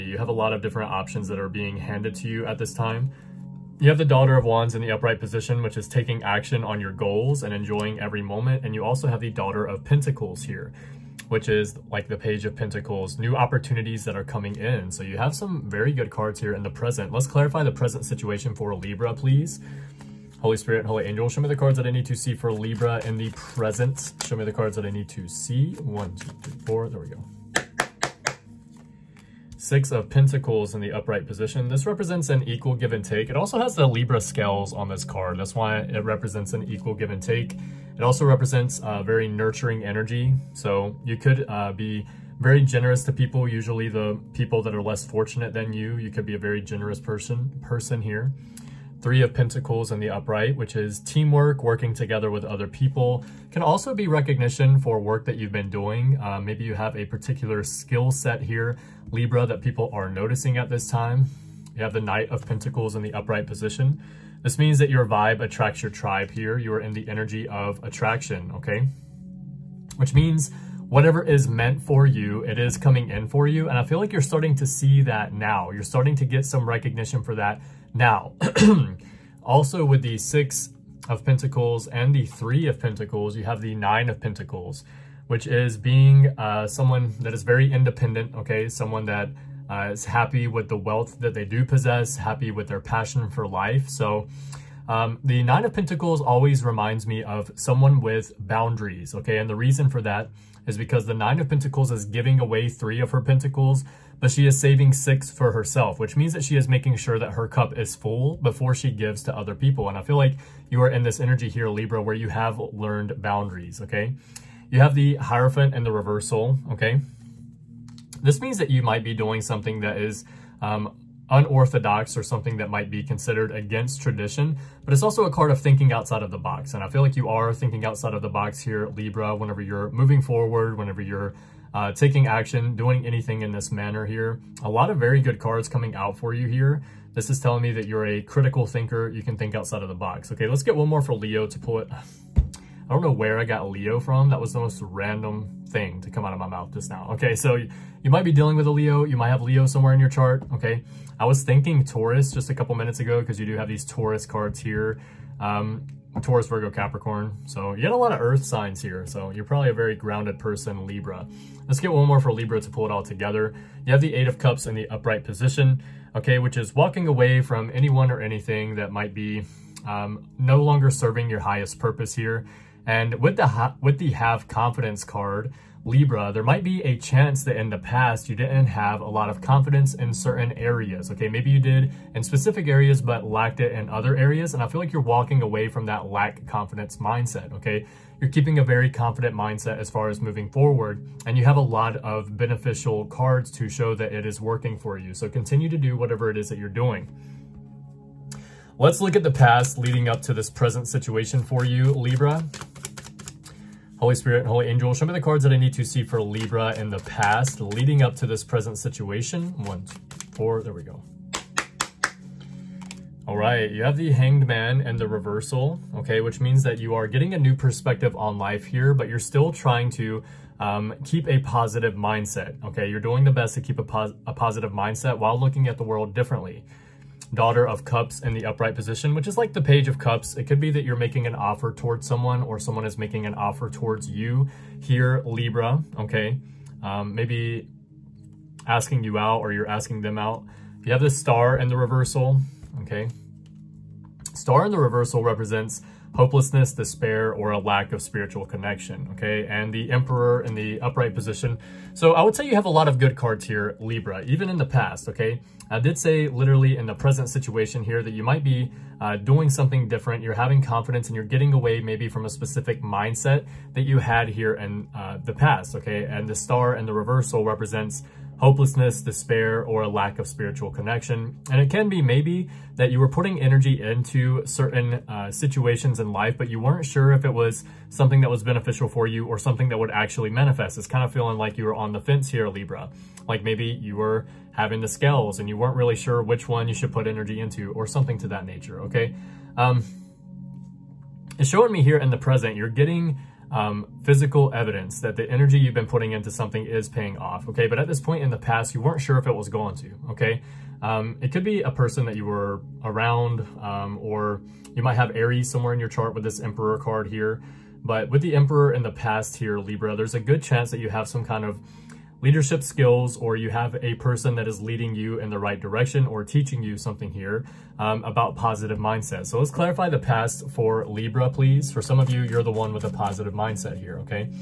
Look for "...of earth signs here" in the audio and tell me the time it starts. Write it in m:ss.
2:38.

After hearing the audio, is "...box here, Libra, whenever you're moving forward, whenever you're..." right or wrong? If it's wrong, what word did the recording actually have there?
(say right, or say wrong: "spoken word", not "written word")
right.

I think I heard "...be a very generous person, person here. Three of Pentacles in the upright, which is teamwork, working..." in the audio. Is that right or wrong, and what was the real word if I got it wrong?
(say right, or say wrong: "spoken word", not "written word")
right.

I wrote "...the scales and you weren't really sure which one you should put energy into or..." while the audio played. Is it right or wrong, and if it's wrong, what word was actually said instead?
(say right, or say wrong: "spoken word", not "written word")
right.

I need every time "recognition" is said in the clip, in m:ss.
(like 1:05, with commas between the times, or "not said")
0:54, 1:16.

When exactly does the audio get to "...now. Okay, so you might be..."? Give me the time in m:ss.
2:26.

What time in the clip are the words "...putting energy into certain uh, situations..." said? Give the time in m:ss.
4:33.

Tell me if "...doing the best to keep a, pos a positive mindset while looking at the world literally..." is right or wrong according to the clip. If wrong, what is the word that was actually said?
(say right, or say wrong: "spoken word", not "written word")
wrong: "differently", not "literally".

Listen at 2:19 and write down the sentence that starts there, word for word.
You can think outside of the box.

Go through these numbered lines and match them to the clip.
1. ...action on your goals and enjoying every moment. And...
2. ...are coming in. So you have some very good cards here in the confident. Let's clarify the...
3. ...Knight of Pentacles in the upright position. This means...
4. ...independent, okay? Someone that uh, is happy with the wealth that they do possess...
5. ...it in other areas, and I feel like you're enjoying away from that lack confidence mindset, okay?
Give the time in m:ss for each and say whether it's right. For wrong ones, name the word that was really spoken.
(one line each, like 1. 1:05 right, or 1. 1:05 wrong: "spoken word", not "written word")
1. 0:06 right
2. 0:14 wrong: "present", not "confident"
3. 1:02 right
4. 1:27 right
5. 3:03 wrong: "walking", not "enjoying".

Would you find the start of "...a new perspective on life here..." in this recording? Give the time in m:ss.
3:37.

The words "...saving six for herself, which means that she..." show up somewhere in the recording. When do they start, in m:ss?
1:44.